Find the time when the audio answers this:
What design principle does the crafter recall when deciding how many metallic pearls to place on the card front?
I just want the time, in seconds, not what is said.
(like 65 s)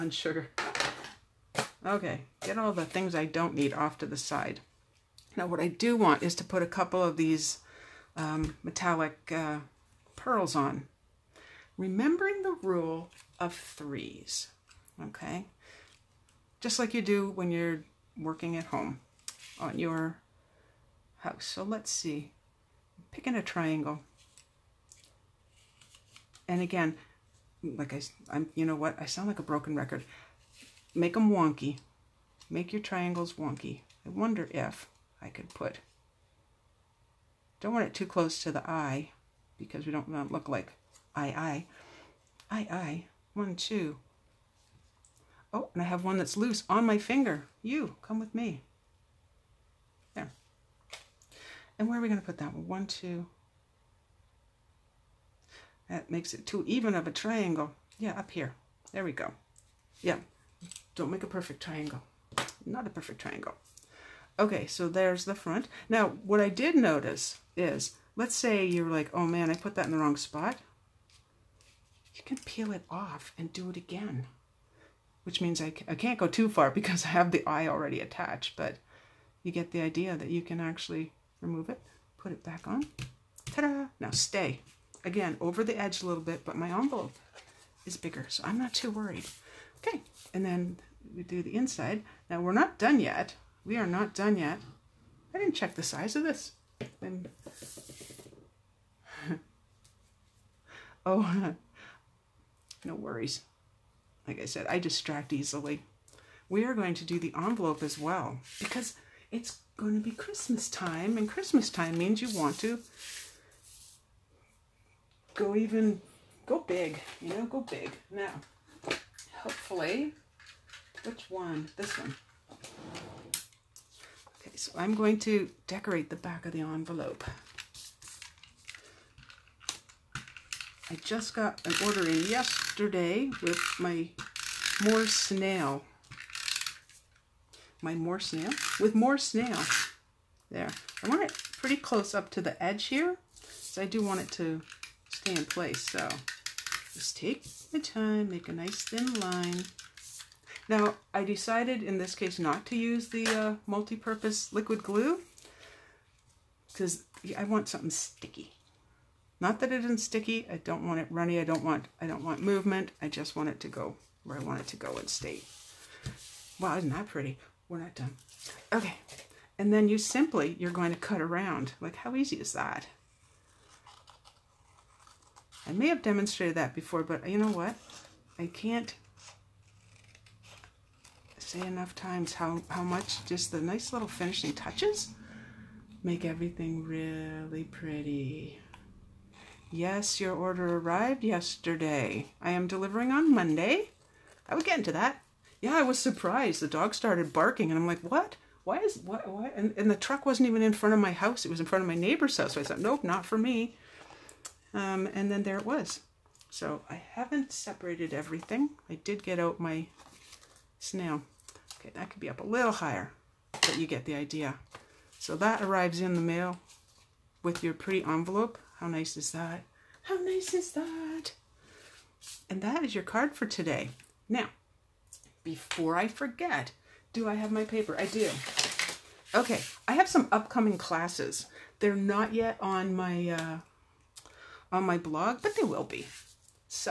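12 s.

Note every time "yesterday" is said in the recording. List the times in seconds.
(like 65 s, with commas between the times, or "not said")
132 s, 191 s.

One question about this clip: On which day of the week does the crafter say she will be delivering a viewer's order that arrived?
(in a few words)
Monday.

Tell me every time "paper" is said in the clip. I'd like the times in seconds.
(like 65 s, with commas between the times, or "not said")
227 s.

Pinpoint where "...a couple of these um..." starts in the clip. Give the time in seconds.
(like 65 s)
6 s.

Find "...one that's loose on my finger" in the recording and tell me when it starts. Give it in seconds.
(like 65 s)
46 s.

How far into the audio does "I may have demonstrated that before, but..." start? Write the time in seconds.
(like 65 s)
175 s.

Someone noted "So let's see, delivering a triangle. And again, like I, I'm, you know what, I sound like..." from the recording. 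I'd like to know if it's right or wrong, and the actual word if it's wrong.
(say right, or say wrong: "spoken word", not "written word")
wrong: "picking", not "delivering".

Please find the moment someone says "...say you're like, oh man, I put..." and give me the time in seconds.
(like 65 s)
68 s.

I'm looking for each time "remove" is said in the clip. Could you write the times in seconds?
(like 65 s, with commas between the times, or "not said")
81 s.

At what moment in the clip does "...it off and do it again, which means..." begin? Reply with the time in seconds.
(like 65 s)
72 s.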